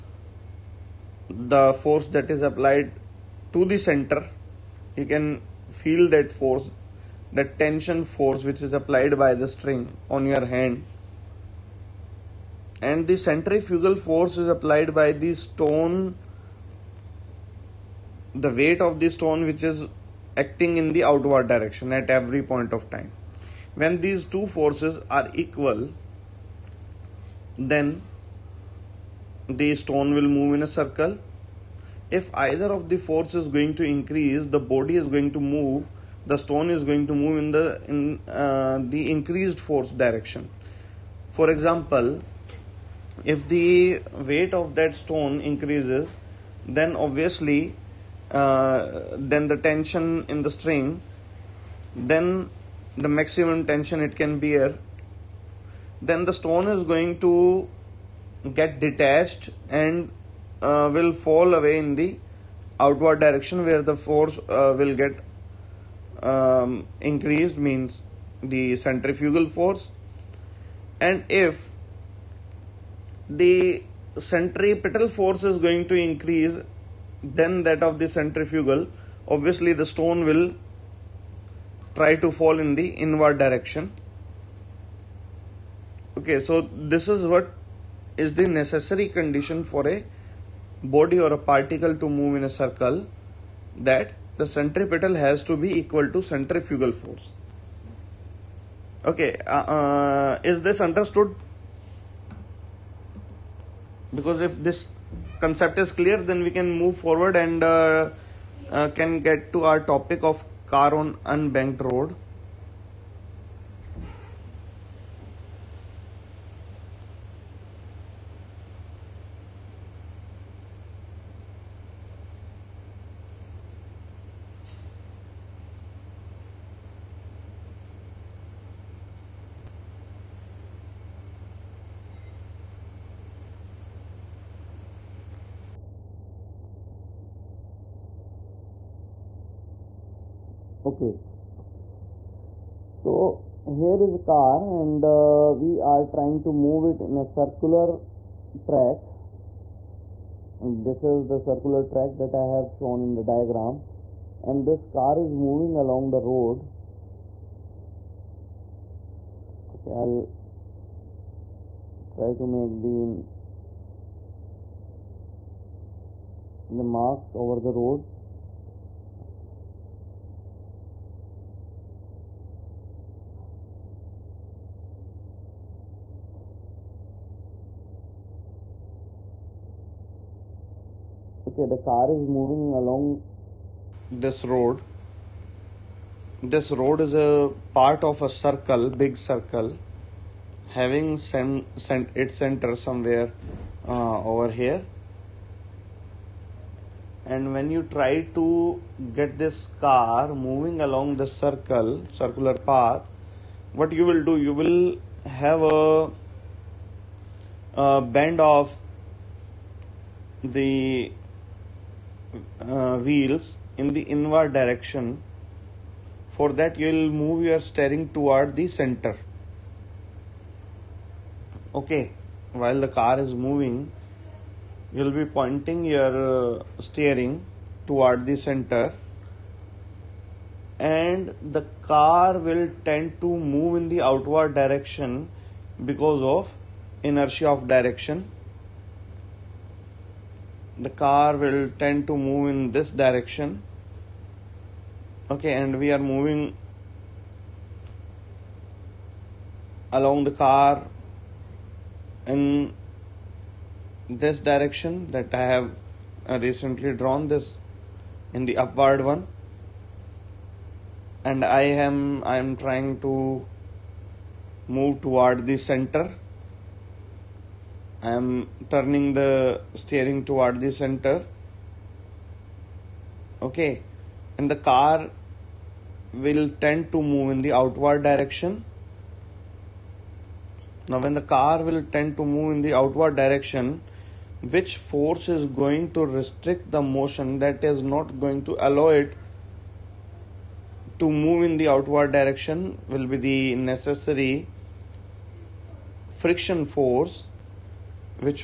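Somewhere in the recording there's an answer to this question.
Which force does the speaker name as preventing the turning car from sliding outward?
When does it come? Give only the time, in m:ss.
4:56.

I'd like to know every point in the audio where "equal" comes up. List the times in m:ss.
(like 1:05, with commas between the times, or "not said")
0:25, 1:35.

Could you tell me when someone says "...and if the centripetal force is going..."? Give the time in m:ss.
1:11.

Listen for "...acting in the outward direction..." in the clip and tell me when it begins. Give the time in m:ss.
0:20.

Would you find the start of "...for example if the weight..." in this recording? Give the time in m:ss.
0:41.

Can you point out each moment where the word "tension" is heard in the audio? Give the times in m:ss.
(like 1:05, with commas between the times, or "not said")
0:07, 0:49, 0:53.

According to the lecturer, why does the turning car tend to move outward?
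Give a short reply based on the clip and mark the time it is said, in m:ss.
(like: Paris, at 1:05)
Inertia of direction, at 3:57.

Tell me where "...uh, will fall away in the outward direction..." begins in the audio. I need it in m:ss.
1:00.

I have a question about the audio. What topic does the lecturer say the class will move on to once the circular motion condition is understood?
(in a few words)
Car on unbanked road.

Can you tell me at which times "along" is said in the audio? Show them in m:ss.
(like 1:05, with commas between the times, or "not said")
2:35, 3:02, 3:20, 4:09.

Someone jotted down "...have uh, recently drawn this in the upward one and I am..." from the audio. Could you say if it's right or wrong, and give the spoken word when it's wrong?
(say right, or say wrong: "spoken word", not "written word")
right.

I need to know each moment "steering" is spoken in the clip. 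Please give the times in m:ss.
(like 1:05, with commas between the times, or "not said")
3:37, 3:46, 4:29.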